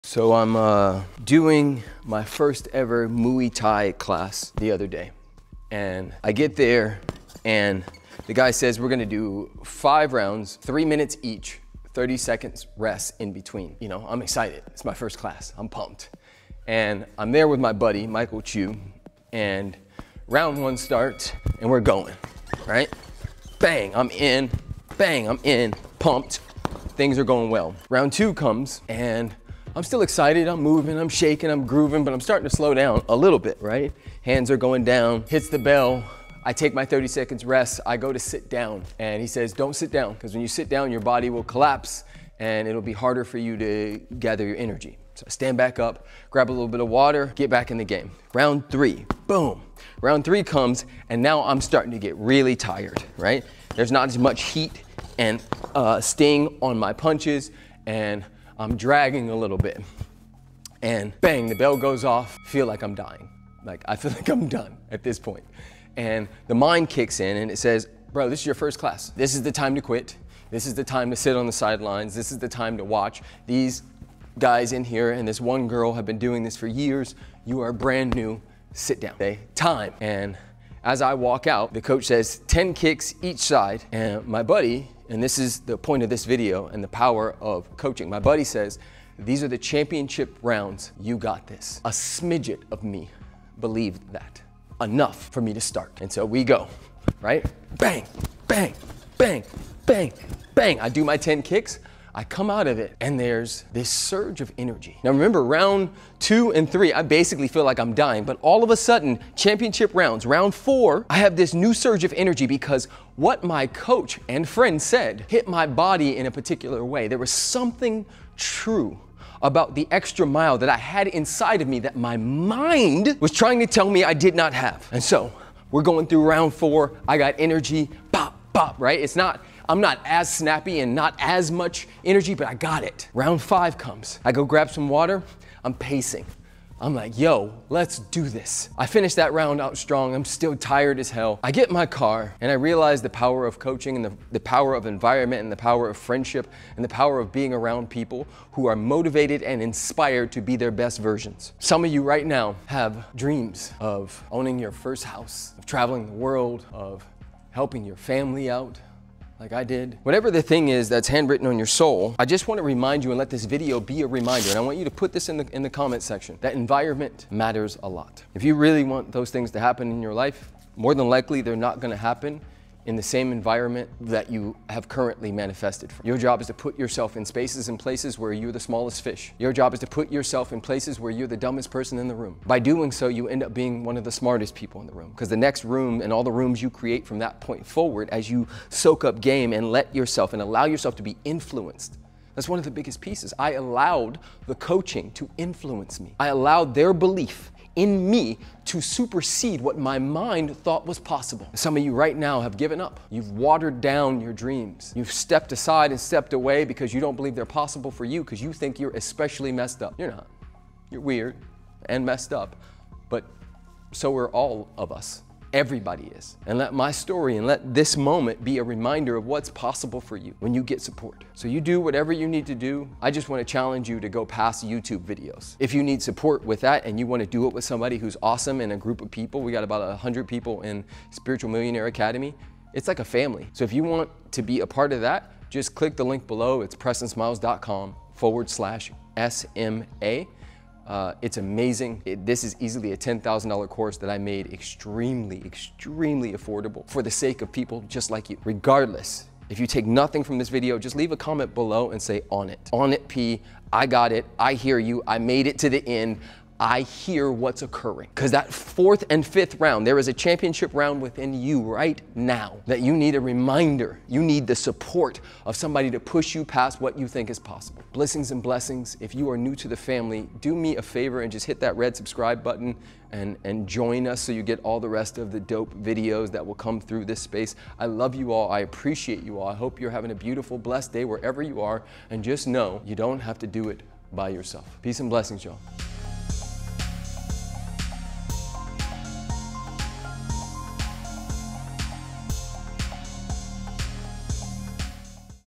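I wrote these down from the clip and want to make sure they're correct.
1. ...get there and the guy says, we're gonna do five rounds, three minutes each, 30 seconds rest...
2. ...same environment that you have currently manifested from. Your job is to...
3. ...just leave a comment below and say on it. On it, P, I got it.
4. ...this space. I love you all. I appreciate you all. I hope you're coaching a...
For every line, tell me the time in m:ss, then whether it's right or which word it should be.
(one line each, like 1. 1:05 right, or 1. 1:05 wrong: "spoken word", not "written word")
1. 0:06 right
2. 2:53 right
3. 4:10 right
4. 4:37 wrong: "having", not "coaching".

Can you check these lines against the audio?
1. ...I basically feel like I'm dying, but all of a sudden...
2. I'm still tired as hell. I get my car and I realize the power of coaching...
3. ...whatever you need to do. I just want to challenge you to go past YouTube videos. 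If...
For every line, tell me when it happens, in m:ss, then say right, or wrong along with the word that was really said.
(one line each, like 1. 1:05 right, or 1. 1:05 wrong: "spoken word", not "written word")
1. 1:46 right
2. 2:20 right
3. 3:41 right.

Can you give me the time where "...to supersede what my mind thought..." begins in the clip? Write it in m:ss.
3:18.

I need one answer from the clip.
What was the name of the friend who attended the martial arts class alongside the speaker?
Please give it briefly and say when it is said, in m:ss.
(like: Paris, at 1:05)
Michael Chu, at 0:18.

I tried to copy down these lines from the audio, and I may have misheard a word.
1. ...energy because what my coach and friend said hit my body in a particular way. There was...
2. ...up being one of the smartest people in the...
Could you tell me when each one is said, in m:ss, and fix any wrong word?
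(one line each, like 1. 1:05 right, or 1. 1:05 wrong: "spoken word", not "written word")
1. 1:52 right
2. 3:03 right.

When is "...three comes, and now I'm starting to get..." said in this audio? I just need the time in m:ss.
0:50.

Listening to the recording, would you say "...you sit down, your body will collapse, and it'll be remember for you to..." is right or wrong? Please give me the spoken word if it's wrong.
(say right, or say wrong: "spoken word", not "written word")
wrong: "harder", not "remember".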